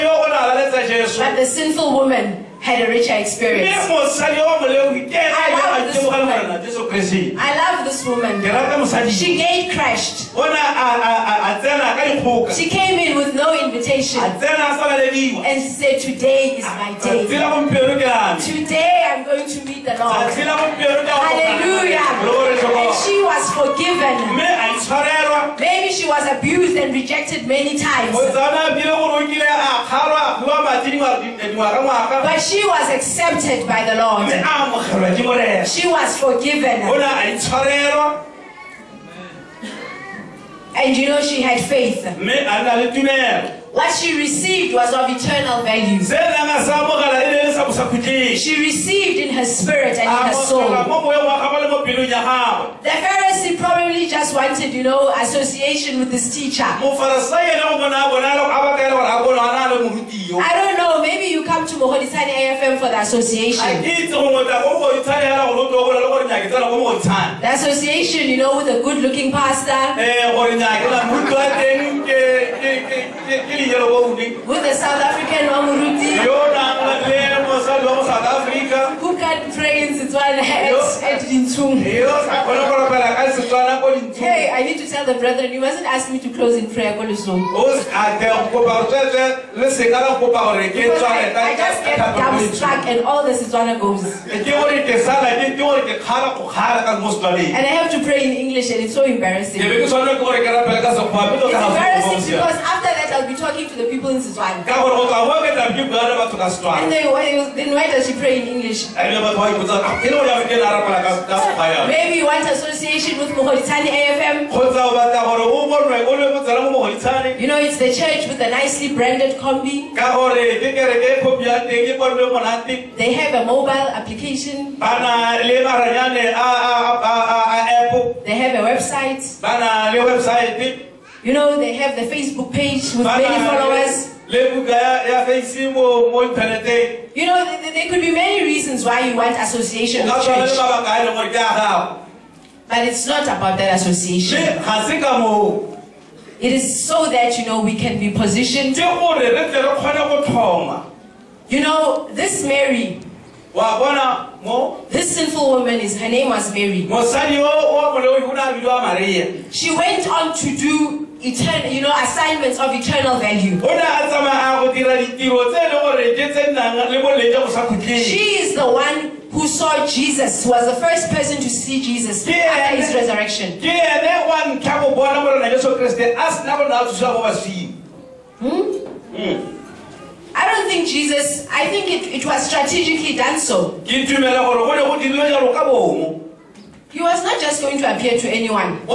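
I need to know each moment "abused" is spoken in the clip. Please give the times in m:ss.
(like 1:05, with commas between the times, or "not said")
0:26.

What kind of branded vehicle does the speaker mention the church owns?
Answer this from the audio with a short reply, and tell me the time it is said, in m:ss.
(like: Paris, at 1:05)
combi, at 1:59.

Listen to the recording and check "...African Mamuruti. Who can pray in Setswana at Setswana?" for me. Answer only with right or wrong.
wrong.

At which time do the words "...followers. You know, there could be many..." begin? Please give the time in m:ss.
2:13.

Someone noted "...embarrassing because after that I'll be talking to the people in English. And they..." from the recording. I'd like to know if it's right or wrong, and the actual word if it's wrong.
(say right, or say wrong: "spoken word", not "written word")
wrong: "Setswana", not "English".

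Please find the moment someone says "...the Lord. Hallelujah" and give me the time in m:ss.
0:19.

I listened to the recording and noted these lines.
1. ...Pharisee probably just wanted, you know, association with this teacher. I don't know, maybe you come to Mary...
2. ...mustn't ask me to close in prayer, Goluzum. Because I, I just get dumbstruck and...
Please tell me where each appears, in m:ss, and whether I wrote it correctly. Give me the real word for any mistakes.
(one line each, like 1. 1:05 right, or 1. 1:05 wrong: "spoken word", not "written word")
1. 0:52 wrong: "Mogoditshane", not "Mary"
2. 1:25 right.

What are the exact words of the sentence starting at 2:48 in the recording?
She is the one who saw Jesus, was the first person to see Jesus after his resurrection.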